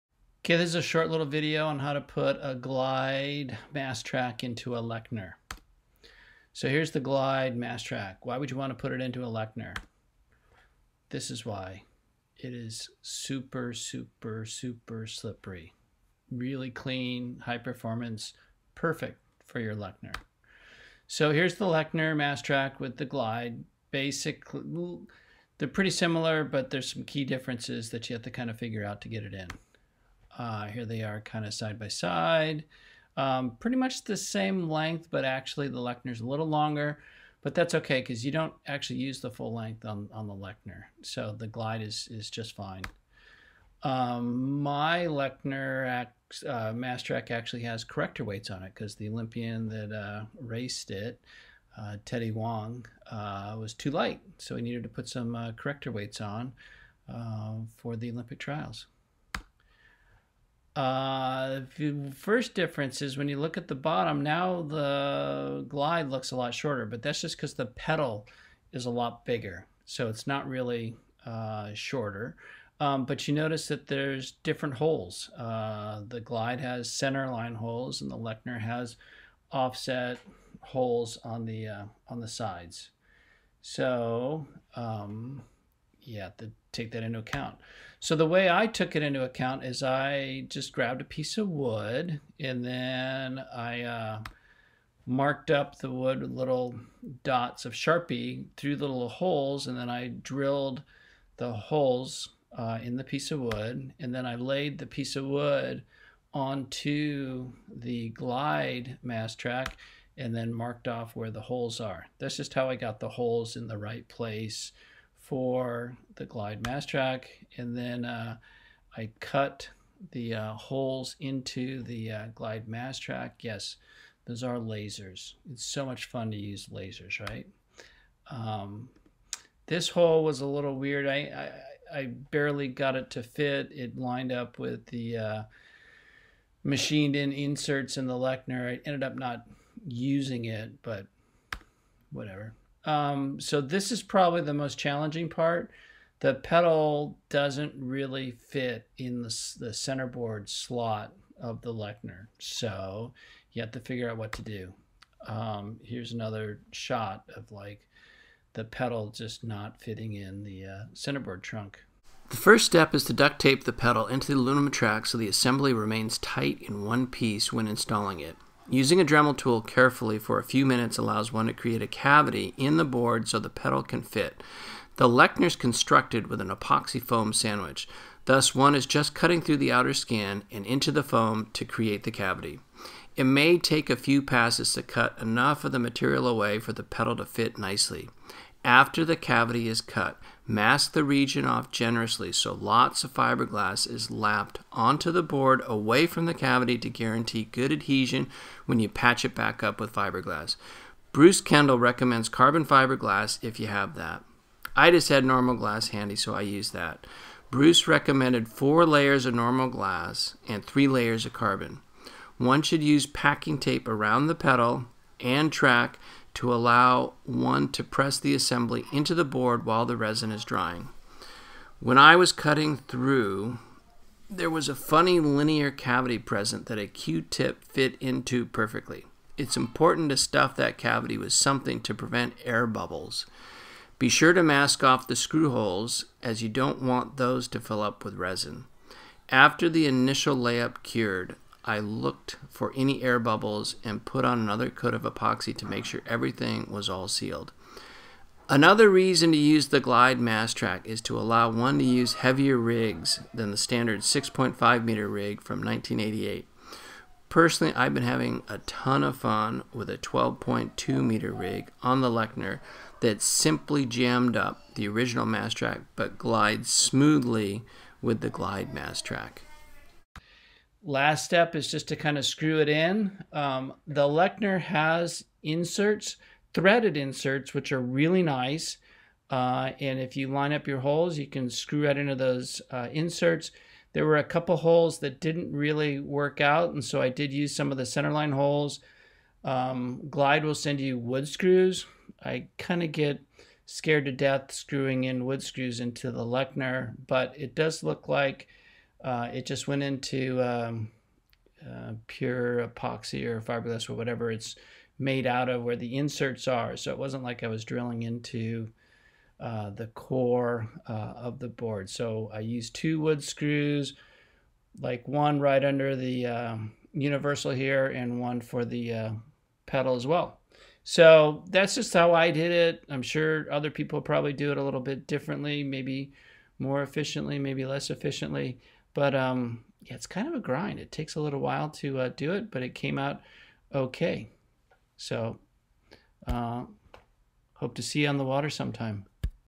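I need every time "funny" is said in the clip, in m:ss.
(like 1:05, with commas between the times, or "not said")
3:44.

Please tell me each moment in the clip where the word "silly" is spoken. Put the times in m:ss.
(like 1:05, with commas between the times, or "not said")
not said.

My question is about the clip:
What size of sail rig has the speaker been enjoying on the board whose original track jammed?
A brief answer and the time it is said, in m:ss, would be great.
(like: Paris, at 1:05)
12.2 meter, at 4:19.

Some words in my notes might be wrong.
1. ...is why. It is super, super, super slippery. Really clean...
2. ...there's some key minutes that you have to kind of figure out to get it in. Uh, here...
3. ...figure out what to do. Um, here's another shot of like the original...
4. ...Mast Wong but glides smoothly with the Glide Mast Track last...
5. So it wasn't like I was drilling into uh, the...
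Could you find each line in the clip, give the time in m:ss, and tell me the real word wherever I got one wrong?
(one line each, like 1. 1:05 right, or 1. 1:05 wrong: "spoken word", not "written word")
1. 0:11 right
2. 0:26 wrong: "differences", not "minutes"
3. 2:33 wrong: "pedal", not "original"
4. 4:25 wrong: "Track", not "Wong"
5. 5:06 right.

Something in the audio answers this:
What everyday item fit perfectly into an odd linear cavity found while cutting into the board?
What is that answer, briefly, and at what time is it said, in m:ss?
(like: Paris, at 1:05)
Q-tip, at 3:46.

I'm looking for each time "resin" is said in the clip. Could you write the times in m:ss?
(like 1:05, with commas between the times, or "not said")
3:39, 3:58.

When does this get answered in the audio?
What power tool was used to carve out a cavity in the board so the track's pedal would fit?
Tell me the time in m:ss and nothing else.
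2:49.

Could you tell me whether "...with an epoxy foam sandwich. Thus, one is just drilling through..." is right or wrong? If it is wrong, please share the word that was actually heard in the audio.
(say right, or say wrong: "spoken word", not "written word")
wrong: "cutting", not "drilling".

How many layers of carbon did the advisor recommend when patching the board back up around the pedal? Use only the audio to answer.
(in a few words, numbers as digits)
3.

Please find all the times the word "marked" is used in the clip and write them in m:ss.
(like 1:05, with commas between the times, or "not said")
1:35, 1:50.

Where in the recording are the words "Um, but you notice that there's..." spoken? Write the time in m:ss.
1:12.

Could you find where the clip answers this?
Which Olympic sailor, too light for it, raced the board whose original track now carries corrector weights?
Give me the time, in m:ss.
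0:52.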